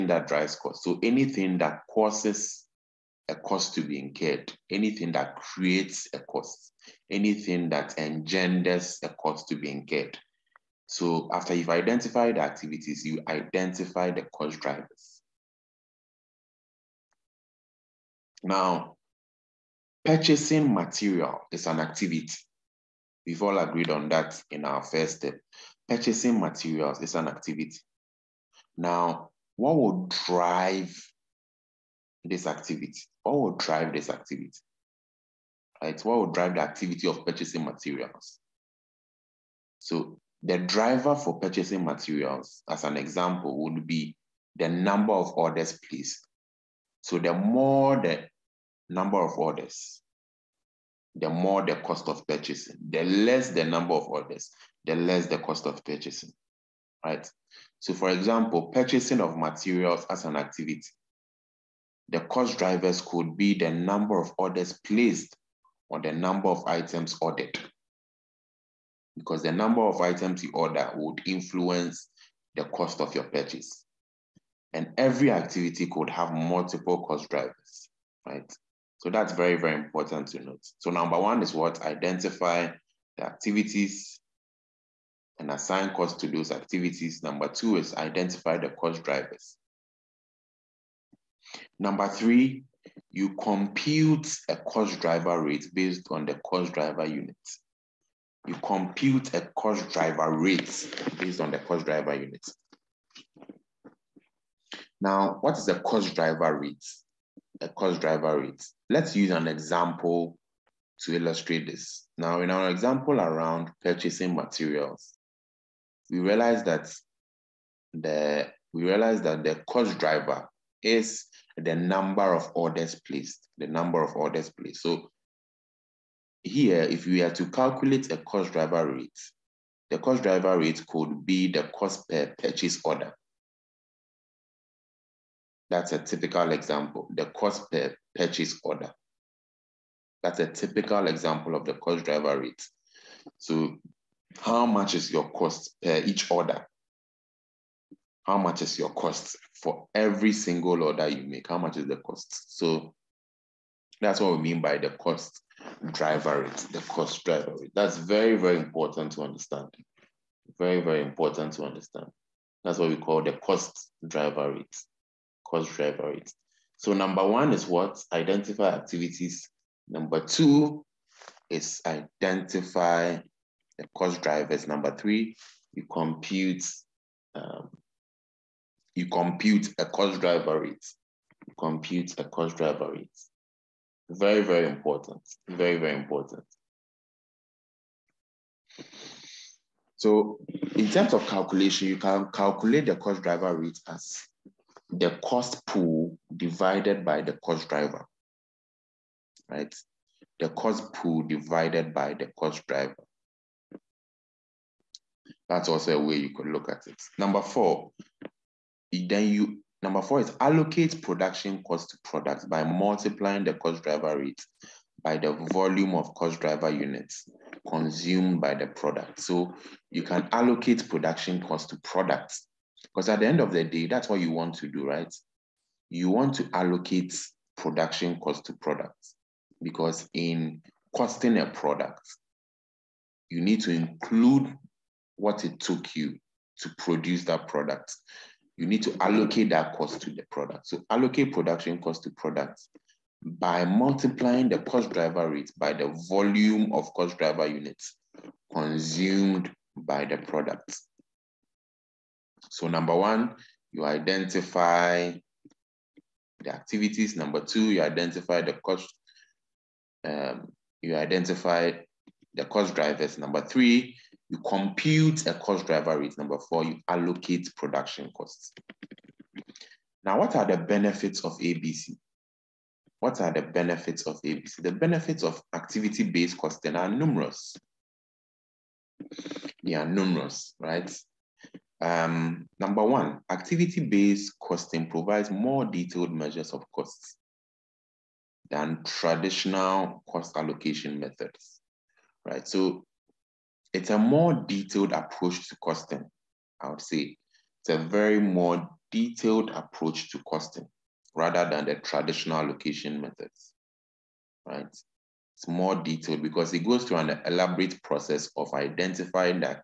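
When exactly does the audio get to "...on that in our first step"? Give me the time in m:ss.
0:23.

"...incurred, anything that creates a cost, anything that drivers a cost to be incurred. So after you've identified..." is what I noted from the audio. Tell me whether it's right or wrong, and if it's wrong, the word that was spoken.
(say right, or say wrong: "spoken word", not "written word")
wrong: "engenders", not "drivers".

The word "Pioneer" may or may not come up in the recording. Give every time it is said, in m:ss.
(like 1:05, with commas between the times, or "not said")
not said.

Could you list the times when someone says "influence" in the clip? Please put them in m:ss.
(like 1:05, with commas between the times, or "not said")
1:11.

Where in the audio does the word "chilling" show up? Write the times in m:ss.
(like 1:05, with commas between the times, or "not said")
not said.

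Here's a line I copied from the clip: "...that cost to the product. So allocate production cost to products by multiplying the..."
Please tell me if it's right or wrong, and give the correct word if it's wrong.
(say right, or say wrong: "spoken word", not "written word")
right.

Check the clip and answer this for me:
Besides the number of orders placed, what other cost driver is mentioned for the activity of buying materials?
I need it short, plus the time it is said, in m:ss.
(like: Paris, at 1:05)
Number of items ordered, at 1:06.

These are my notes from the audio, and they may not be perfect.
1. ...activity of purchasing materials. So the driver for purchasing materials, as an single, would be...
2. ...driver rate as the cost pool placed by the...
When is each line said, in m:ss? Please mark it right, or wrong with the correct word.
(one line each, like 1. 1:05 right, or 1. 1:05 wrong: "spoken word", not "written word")
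1. 0:36 wrong: "example", not "single"
2. 3:13 wrong: "divided", not "placed".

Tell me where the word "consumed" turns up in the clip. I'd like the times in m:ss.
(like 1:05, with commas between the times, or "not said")
3:37, 4:08.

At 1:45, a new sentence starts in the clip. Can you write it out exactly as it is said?
Now, what is the cost driver rate?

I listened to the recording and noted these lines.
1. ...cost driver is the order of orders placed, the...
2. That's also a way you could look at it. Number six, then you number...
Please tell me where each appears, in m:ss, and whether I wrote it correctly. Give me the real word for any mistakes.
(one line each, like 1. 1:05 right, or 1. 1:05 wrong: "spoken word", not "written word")
1. 1:59 wrong: "number", not "order"
2. 3:25 wrong: "four", not "six".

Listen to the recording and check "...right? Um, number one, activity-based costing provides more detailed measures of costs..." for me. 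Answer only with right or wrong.
right.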